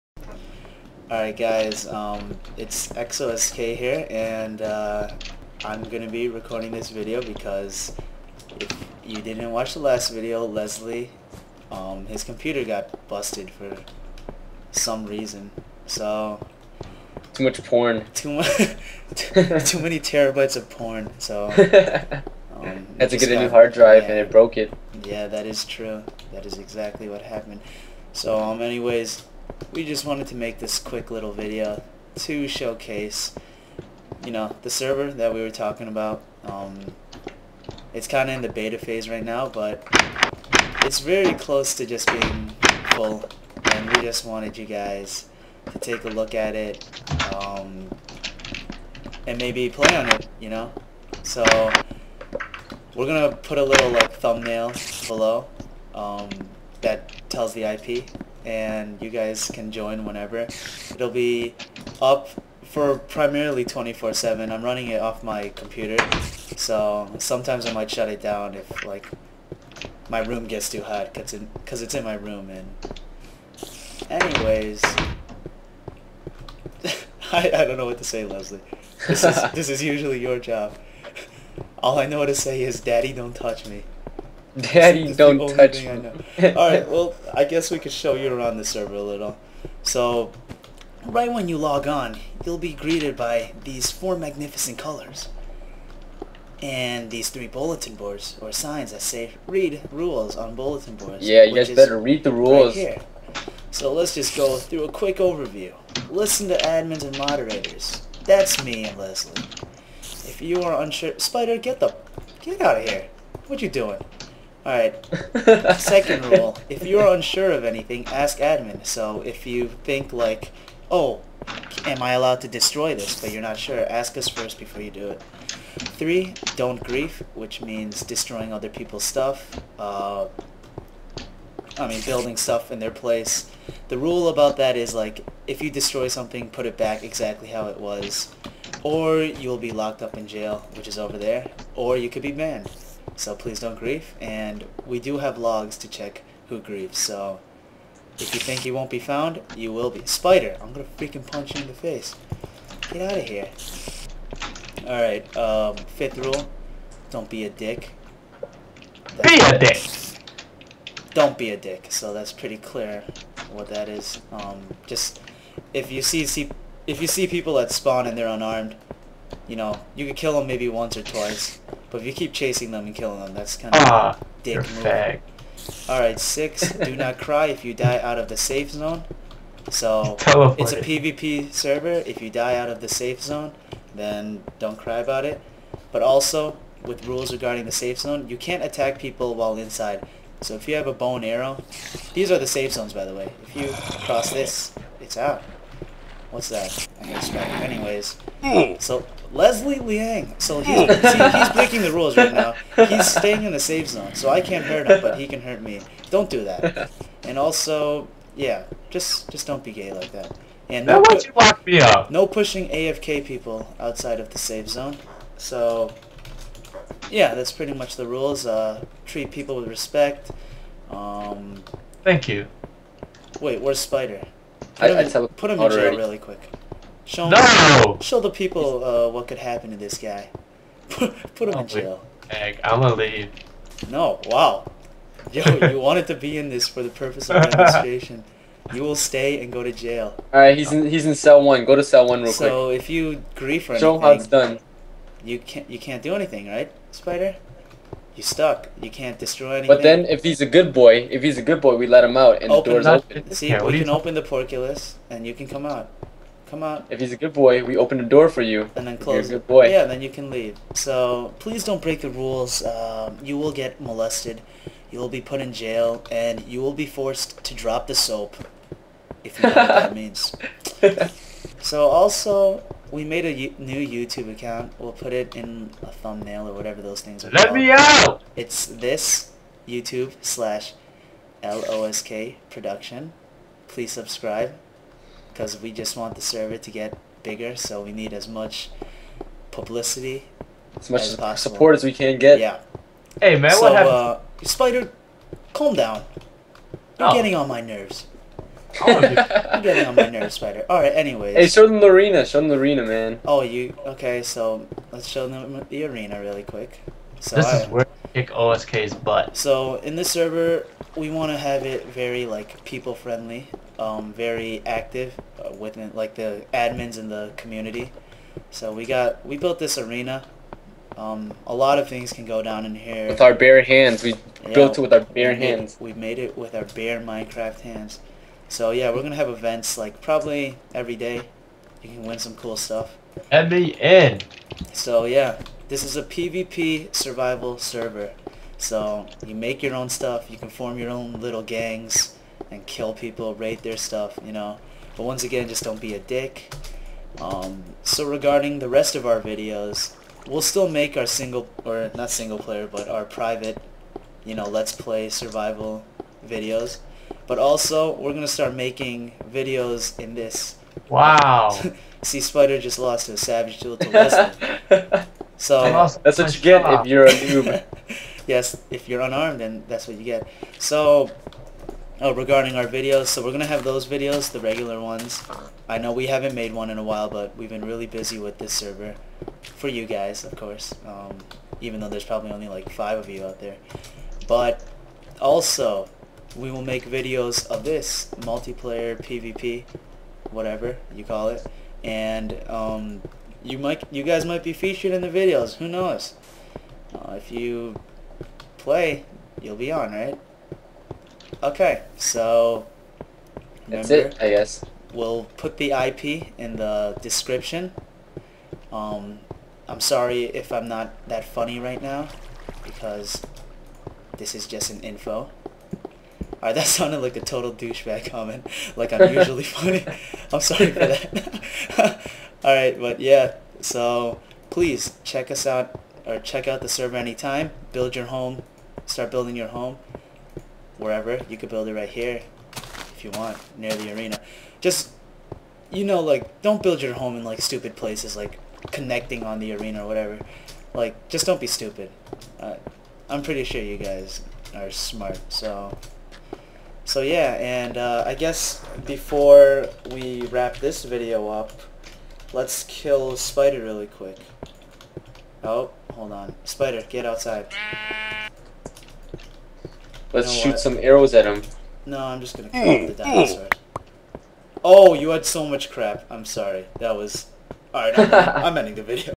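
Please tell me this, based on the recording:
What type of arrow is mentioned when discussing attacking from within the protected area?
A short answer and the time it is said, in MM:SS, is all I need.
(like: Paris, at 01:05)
Bone arrow, at 03:10.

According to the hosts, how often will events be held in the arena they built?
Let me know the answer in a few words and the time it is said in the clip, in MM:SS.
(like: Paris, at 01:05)
Probably every day, at 05:30.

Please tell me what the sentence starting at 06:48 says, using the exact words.
Um, I'm sorry if I'm not that funny right now, because this is just an info.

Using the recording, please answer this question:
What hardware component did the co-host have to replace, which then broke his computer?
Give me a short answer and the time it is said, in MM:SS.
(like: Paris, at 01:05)
Hard drive, at 00:23.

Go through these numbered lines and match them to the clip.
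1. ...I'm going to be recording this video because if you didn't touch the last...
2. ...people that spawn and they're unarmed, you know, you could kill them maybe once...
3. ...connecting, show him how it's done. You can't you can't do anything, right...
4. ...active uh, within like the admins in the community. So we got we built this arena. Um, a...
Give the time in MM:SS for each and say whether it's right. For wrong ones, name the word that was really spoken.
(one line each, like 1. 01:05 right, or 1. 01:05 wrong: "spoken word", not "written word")
1. 00:05 wrong: "watch", not "touch"
2. 02:47 right
3. 04:03 wrong: "anything", not "connecting"
4. 05:14 right.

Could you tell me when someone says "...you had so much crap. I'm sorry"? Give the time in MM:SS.
07:44.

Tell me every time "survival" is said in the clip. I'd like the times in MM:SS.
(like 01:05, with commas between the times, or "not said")
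05:36, 05:55.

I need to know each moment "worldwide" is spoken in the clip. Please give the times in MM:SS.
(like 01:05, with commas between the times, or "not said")
not said.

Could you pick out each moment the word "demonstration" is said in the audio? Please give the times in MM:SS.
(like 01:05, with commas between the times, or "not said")
03:57.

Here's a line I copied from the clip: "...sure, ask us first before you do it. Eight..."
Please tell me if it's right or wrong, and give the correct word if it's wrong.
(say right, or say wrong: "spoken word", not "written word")
wrong: "Three", not "Eight".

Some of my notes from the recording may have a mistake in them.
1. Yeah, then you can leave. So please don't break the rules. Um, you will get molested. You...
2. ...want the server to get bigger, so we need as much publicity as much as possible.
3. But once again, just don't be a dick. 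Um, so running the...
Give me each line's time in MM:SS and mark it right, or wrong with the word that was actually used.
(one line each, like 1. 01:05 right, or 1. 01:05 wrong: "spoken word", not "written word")
1. 04:19 right
2. 04:45 right
3. 05:44 wrong: "regarding", not "running".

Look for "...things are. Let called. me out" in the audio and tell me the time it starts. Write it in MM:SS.
04:37.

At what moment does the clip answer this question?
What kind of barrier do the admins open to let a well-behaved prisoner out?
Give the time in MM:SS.
04:14.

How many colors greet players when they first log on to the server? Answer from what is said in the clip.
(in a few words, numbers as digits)
4.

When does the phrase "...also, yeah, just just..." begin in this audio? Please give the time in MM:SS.
03:27.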